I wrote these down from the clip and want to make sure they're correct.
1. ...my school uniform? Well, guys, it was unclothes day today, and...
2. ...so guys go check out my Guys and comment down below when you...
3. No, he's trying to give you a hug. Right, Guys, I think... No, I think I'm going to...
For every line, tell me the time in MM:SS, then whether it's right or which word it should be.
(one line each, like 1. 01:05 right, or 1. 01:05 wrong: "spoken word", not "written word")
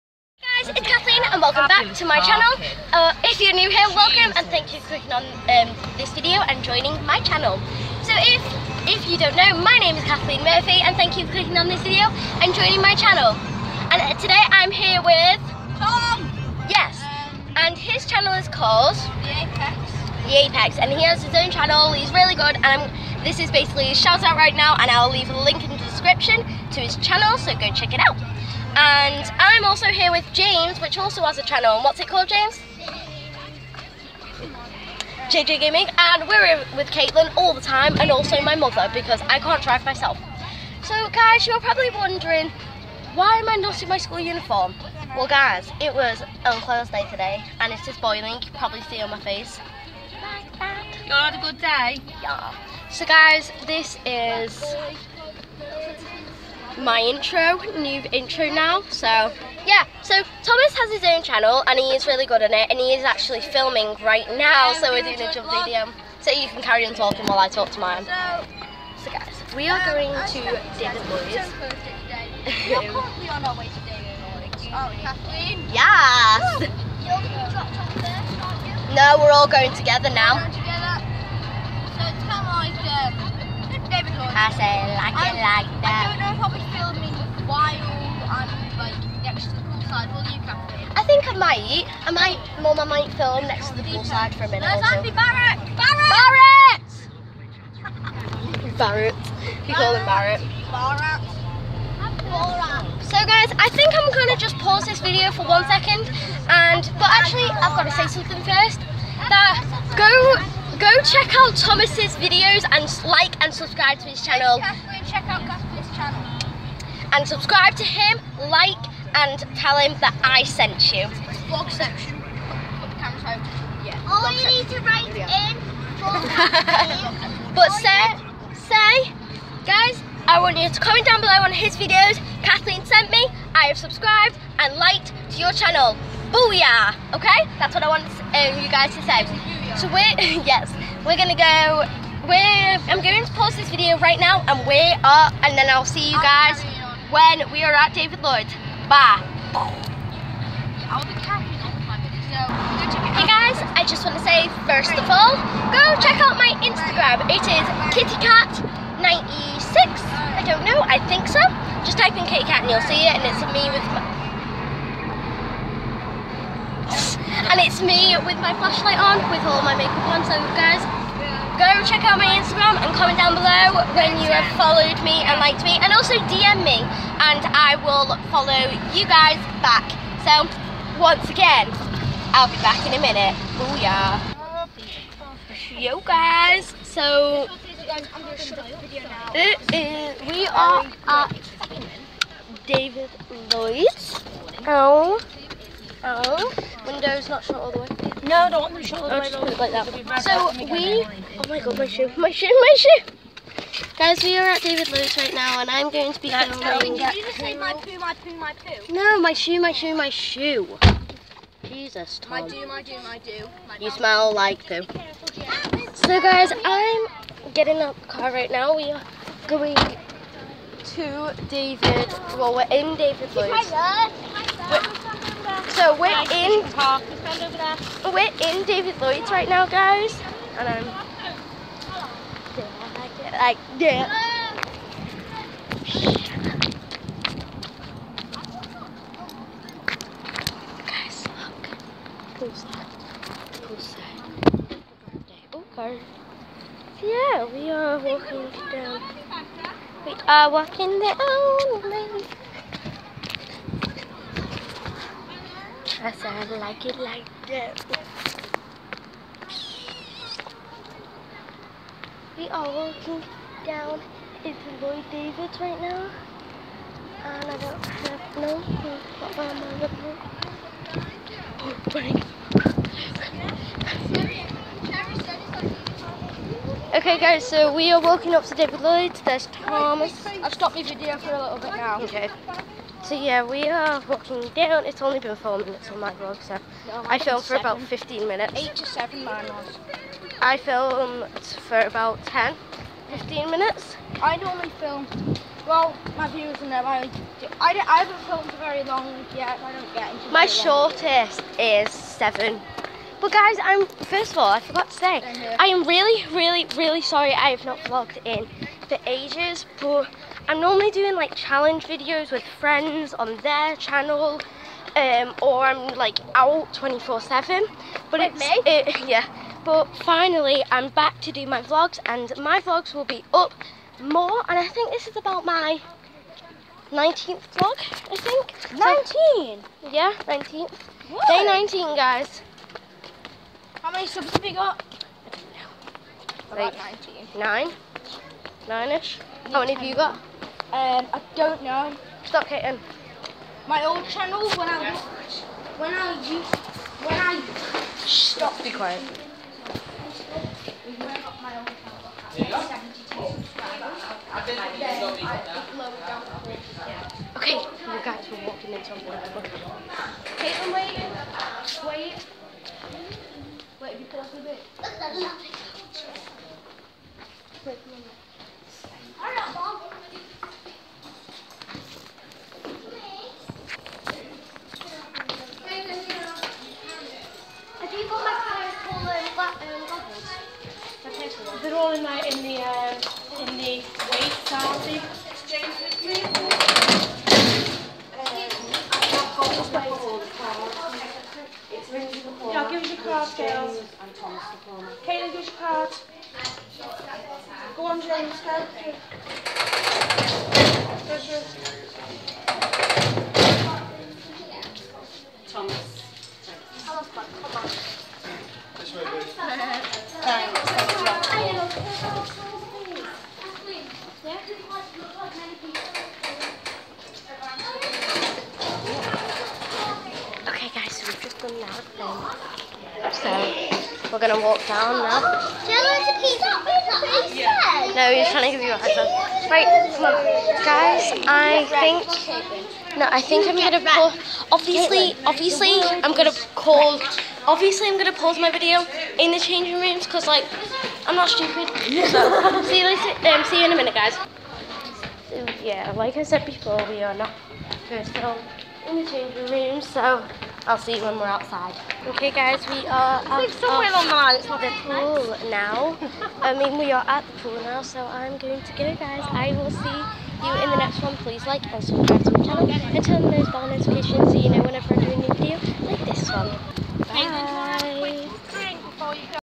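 1. 00:43 right
2. 02:50 wrong: "Instagram", not "Guys"
3. 07:07 right.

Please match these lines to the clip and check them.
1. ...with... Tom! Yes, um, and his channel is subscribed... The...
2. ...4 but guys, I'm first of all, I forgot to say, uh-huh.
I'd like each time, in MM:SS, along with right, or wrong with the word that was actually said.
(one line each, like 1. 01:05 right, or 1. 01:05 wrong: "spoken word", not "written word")
1. 00:15 wrong: "called", not "subscribed"
2. 05:01 wrong: "7", not "4".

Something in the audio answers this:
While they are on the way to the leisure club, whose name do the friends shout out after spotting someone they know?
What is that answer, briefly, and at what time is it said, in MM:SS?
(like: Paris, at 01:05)
Andy Barrett, at 01:34.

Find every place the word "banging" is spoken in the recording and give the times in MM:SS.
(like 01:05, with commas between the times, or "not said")
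not said.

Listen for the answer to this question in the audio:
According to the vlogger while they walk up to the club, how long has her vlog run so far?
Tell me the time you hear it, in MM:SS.
04:45.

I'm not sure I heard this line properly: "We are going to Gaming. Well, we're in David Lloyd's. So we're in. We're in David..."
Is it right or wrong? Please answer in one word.
wrong.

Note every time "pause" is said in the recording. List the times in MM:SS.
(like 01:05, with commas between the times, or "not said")
01:44, 02:23, 07:18.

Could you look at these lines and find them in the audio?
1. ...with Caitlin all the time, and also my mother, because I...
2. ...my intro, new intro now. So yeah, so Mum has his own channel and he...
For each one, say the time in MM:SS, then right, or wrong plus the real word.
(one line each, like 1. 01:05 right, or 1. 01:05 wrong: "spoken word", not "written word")
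1. 00:36 right
2. 00:56 wrong: "Thomas", not "Mum".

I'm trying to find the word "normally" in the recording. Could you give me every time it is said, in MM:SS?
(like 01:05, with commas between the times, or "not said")
04:54, 05:10.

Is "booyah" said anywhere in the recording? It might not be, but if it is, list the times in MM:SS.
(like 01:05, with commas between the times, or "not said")
02:16, 03:03.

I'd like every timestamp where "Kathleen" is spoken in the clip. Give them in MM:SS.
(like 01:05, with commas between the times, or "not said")
00:10, 02:12.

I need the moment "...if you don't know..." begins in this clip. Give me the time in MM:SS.
00:08.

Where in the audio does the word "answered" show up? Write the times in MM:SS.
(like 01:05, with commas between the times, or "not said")
not said.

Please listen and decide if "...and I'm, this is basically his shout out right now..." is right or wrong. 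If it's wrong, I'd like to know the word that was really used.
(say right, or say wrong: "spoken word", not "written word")
right.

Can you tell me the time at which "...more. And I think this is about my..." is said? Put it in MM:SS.
05:24.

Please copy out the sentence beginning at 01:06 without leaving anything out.
So you can carry on talking while I talk to mine.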